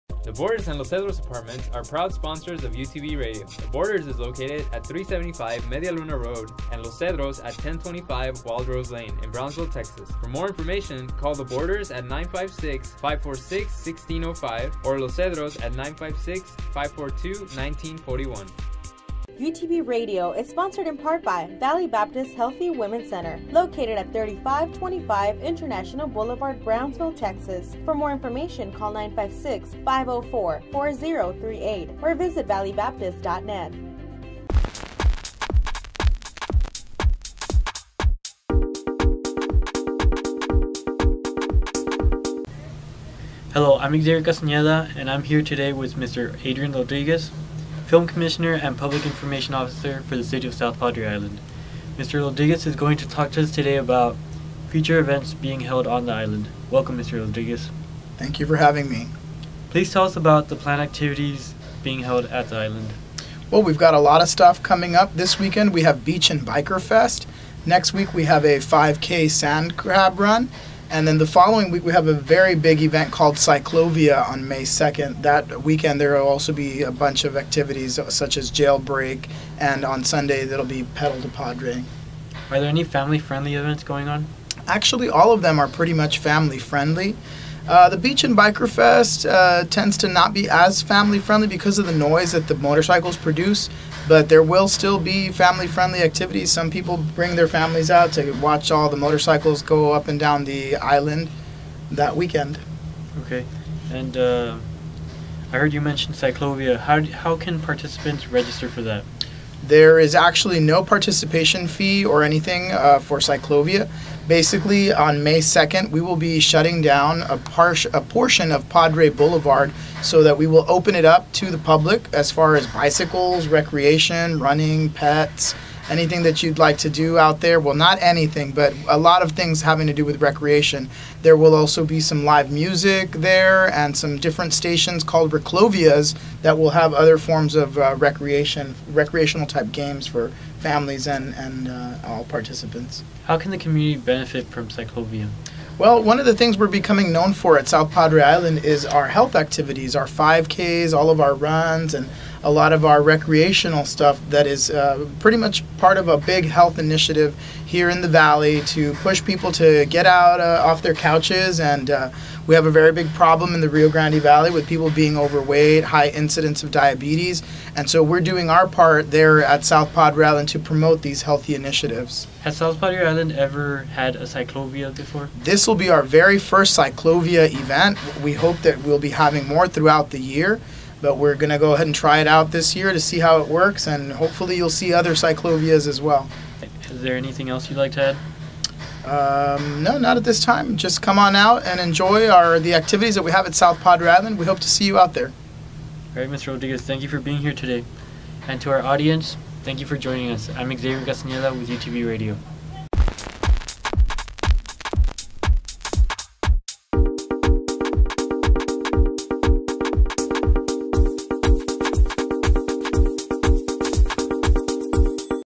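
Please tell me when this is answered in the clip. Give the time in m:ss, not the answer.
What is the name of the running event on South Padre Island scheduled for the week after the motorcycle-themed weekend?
1:08.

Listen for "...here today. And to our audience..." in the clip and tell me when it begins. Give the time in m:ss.
3:17.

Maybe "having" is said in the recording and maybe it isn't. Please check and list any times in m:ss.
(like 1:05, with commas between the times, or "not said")
0:58, 2:09, 2:59.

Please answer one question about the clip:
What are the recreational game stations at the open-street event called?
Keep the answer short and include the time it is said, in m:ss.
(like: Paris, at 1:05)
Reclovias, at 2:15.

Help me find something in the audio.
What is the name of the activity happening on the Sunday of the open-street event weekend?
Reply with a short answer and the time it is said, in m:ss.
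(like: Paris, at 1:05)
Pedal to Padre, at 1:20.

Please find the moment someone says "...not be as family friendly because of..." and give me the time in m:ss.
1:30.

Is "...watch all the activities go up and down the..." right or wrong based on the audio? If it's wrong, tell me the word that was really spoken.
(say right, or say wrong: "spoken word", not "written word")
wrong: "motorcycles", not "activities".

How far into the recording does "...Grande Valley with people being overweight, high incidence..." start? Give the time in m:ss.
2:43.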